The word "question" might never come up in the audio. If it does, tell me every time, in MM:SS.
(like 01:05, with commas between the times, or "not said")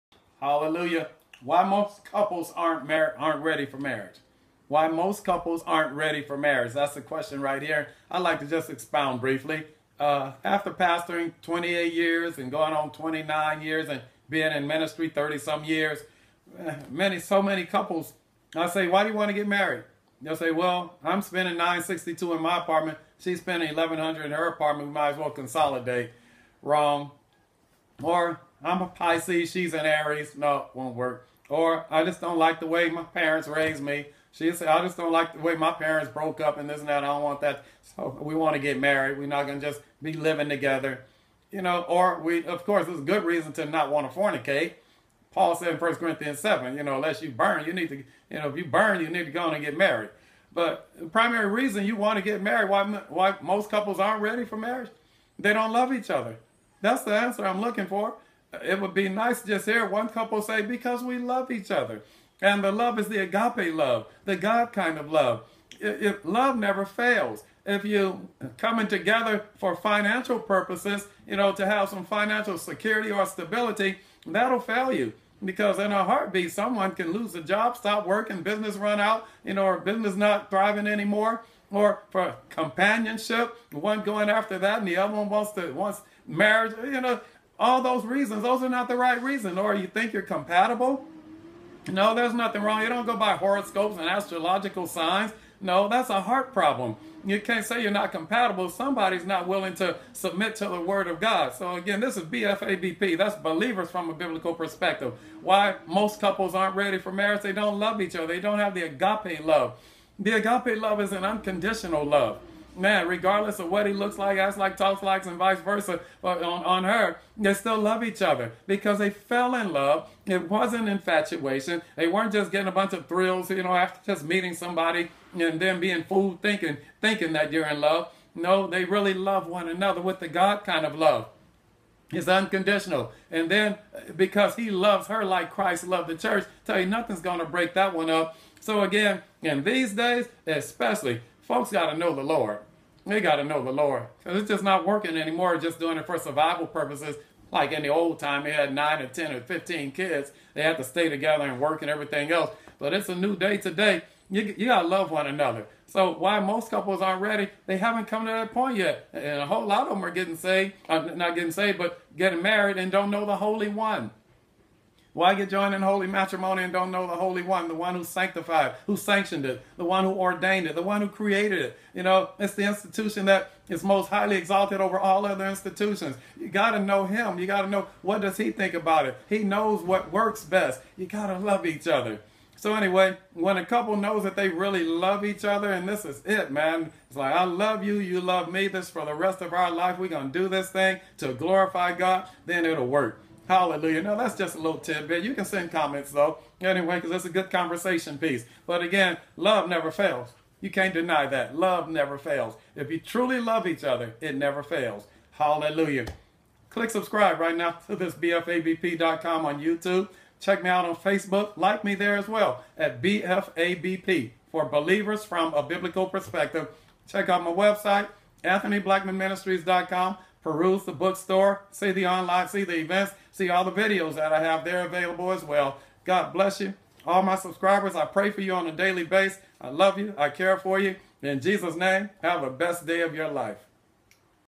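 00:07.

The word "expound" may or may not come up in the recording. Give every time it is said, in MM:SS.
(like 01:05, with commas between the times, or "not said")
00:08.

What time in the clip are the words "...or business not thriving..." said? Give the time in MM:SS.
01:19.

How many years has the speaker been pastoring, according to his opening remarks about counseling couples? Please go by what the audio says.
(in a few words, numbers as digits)
28.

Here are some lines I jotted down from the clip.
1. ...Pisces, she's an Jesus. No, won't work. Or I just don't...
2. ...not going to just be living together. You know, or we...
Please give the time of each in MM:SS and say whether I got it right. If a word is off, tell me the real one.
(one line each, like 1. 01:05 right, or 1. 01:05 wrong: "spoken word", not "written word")
1. 00:28 wrong: "Aries", not "Jesus"
2. 00:39 right.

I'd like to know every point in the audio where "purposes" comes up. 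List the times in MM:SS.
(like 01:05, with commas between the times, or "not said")
01:10, 02:26.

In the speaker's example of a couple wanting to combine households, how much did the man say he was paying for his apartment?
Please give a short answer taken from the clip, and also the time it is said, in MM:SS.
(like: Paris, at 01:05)
962, at 00:21.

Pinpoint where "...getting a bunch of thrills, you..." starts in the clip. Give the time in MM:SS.
02:02.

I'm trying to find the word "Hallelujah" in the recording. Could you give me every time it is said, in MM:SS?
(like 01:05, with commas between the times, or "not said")
00:00, 03:13, 03:25.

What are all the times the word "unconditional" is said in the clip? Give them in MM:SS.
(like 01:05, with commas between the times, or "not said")
01:51, 02:12.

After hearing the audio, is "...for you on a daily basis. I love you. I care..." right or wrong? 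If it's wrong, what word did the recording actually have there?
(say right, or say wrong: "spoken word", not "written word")
right.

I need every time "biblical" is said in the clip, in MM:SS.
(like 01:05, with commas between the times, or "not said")
01:44, 03:35.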